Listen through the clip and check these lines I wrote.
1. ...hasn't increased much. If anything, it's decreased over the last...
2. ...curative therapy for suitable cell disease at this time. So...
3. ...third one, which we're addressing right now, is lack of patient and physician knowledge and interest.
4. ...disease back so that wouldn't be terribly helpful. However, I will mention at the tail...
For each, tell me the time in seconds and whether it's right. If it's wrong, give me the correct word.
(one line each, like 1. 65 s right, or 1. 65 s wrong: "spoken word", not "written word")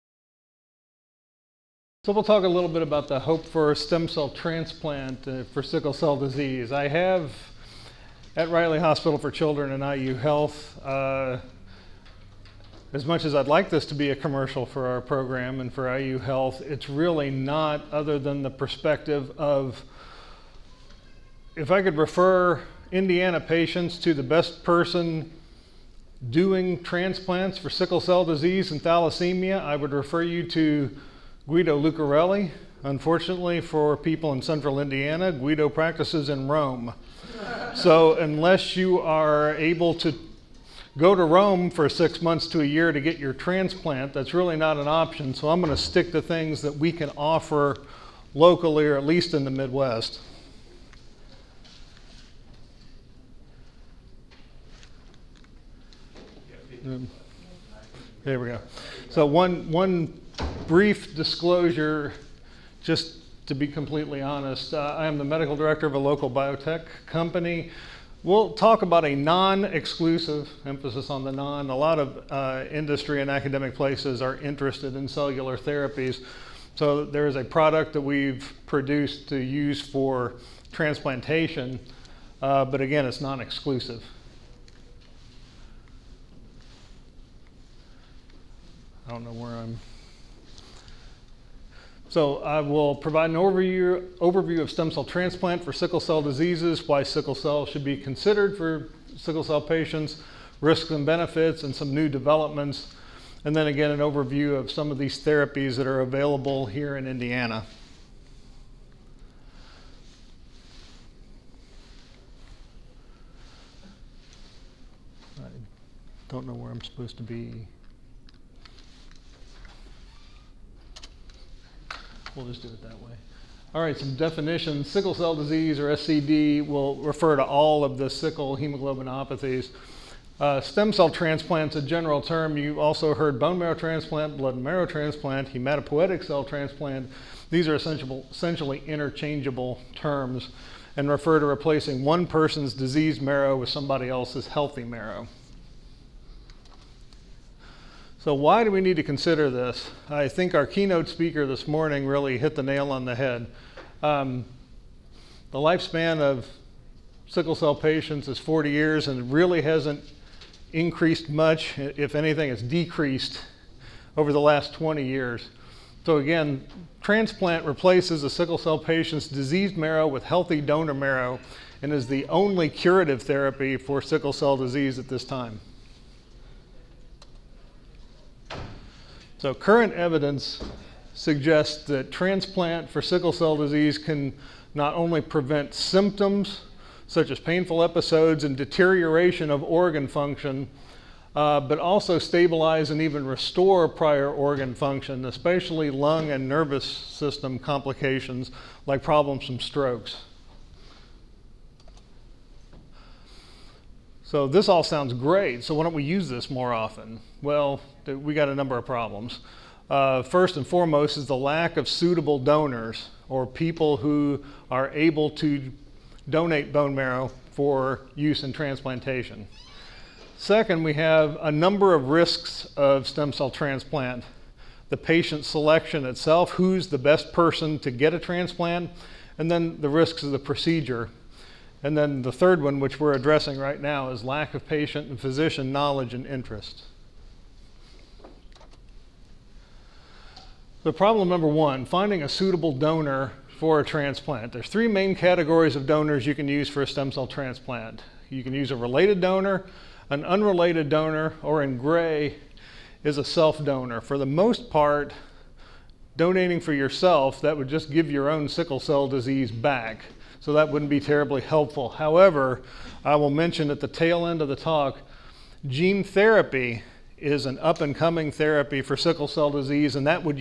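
1. 159 s right
2. 172 s wrong: "sickle", not "suitable"
3. 232 s right
4. 259 s right.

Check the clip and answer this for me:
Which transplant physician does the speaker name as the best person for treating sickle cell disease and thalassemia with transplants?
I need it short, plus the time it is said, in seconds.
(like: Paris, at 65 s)
Guido Lucarelli, at 31 s.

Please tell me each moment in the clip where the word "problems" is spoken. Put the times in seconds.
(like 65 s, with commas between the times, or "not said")
199 s, 208 s, 240 s.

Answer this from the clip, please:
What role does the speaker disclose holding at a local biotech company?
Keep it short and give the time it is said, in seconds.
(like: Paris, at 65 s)
medical director, at 65 s.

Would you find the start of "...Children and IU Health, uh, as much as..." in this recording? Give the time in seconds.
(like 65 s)
9 s.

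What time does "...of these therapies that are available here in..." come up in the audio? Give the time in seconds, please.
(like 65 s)
104 s.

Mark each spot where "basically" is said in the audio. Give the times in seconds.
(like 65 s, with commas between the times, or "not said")
not said.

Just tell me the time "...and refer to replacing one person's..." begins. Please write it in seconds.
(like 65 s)
140 s.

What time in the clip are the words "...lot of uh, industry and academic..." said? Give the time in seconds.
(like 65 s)
71 s.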